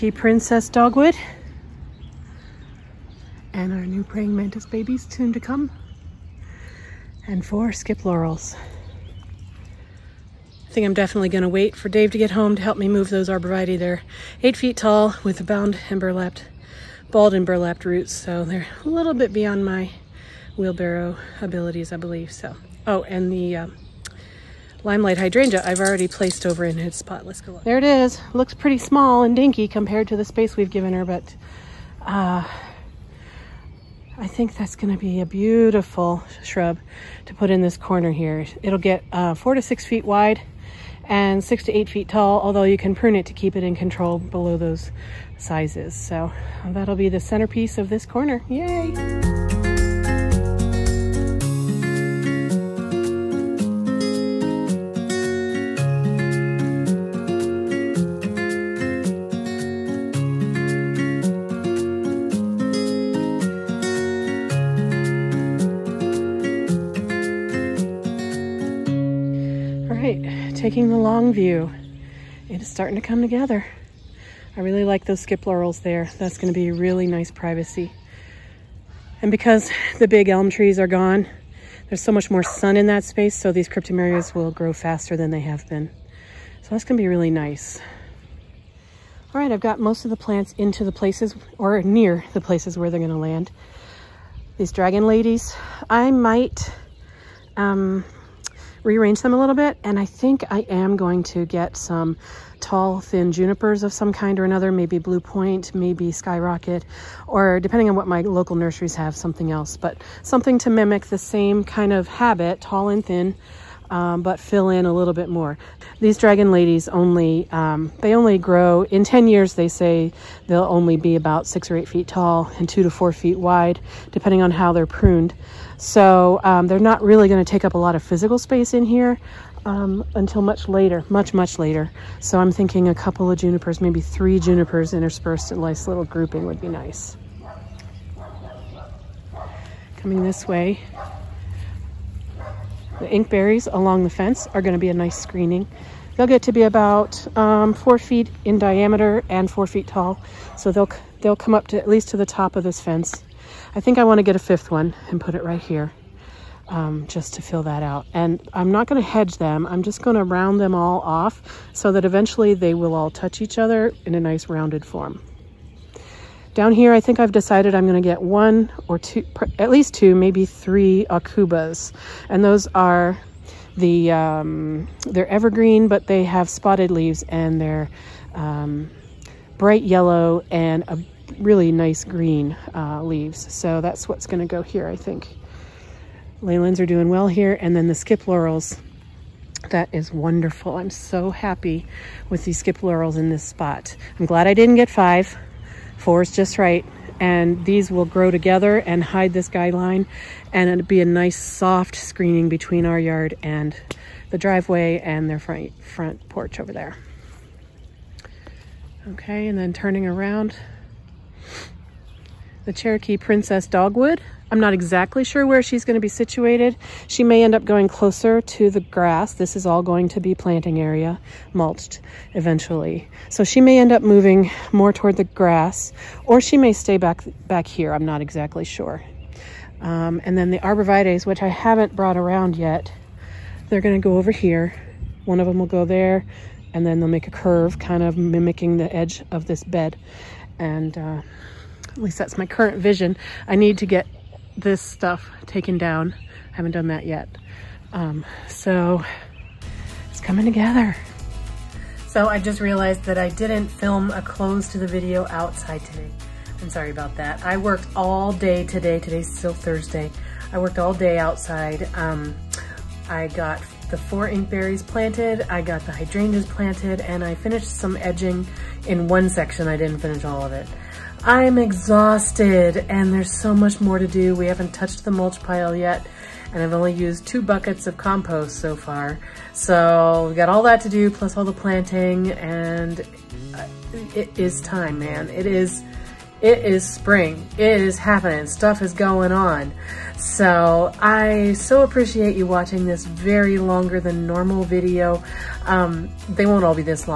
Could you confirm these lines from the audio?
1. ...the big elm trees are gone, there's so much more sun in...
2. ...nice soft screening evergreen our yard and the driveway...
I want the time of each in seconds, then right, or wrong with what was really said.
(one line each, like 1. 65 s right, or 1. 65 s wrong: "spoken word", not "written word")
1. 79 s right
2. 201 s wrong: "between", not "evergreen".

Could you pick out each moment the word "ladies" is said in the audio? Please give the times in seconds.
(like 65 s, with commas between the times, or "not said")
95 s, 116 s.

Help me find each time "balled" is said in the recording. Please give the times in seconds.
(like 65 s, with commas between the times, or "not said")
17 s.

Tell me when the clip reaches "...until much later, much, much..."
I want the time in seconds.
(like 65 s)
130 s.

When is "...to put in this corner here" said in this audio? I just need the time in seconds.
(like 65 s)
37 s.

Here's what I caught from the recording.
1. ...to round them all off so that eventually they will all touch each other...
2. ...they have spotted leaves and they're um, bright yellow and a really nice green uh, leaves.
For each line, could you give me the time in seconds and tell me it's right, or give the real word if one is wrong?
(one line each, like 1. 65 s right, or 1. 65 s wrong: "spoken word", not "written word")
1. 160 s right
2. 176 s right.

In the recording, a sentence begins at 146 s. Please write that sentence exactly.
They'll get to be about um, four feet in diameter and four feet tall.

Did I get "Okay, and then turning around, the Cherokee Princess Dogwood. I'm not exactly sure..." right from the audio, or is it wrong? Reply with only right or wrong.
right.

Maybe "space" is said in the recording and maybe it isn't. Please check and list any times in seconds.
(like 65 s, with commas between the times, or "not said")
30 s, 83 s, 128 s.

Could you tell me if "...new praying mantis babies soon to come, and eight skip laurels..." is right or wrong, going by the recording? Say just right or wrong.
wrong.